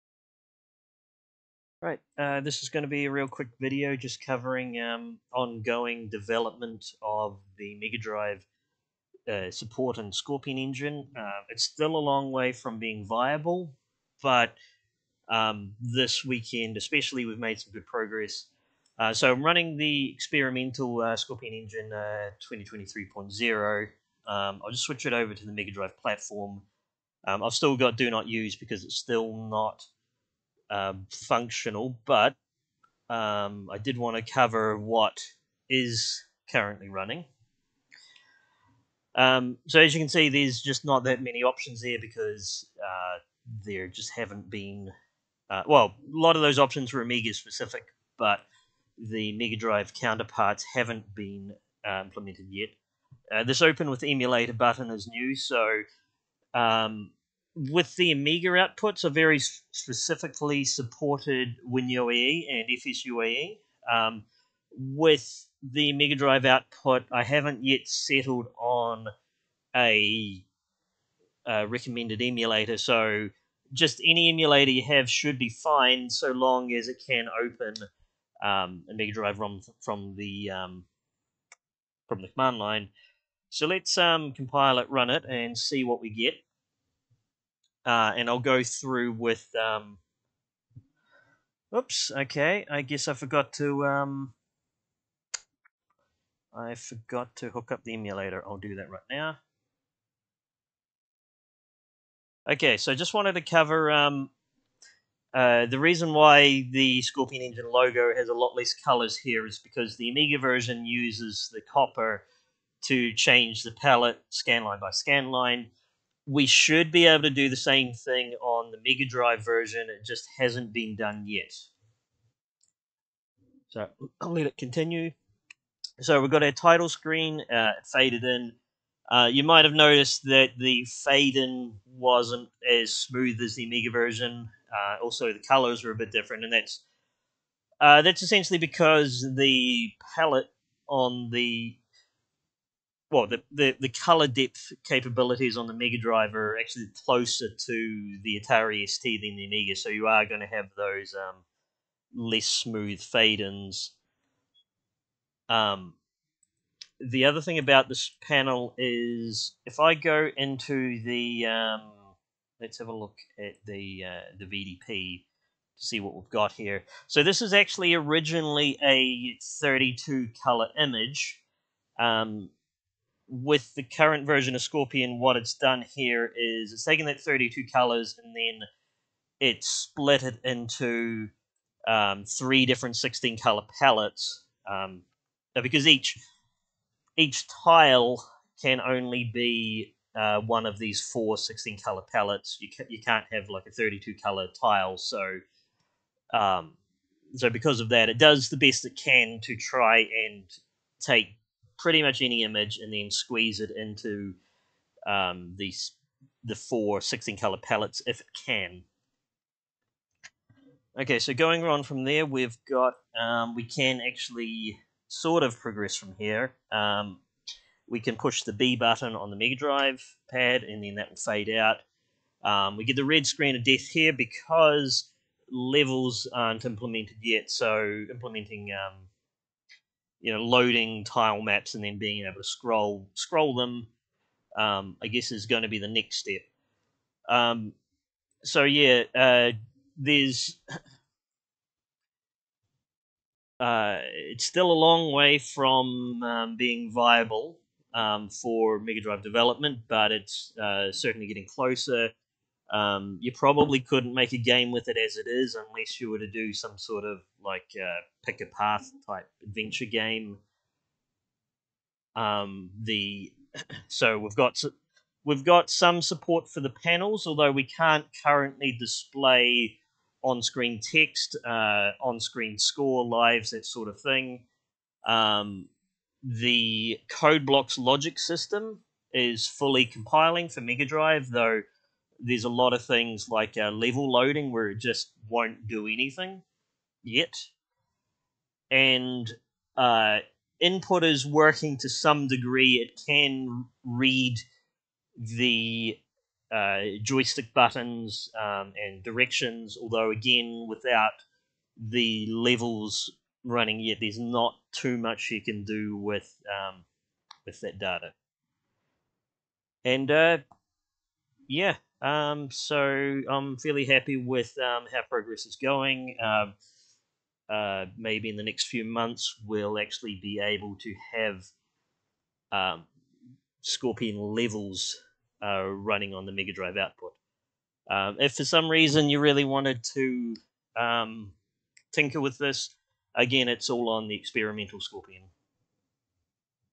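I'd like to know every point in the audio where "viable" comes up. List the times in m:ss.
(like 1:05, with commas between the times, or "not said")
0:13, 4:06.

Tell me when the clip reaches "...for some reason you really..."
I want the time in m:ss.
5:28.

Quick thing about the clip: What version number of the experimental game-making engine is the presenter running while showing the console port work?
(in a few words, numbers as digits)
2023.0.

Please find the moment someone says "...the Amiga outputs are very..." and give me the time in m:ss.
0:57.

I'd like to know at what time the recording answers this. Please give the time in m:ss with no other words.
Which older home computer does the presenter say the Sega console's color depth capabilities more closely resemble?
2:28.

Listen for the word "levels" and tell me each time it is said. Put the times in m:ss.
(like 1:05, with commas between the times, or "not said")
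3:45, 4:43, 5:02, 5:24.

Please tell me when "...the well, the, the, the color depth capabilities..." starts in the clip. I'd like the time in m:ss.
2:21.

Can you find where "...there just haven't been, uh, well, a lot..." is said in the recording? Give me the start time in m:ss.
0:43.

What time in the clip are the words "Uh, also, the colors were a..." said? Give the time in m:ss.
2:14.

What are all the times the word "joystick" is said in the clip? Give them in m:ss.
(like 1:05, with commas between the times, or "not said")
4:57.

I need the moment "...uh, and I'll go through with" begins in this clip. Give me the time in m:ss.
1:27.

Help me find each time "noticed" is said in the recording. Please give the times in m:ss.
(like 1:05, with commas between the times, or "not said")
2:09.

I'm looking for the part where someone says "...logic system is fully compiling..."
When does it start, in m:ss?
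4:37.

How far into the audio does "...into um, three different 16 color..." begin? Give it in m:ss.
3:00.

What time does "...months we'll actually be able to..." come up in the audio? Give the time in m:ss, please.
5:18.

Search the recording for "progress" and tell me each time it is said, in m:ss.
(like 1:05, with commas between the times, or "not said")
0:17, 3:35, 5:15.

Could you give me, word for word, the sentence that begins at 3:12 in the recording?
You ca- you can't have like a 32 color tile.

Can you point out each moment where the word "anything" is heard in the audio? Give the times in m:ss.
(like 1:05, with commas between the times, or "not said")
4:45.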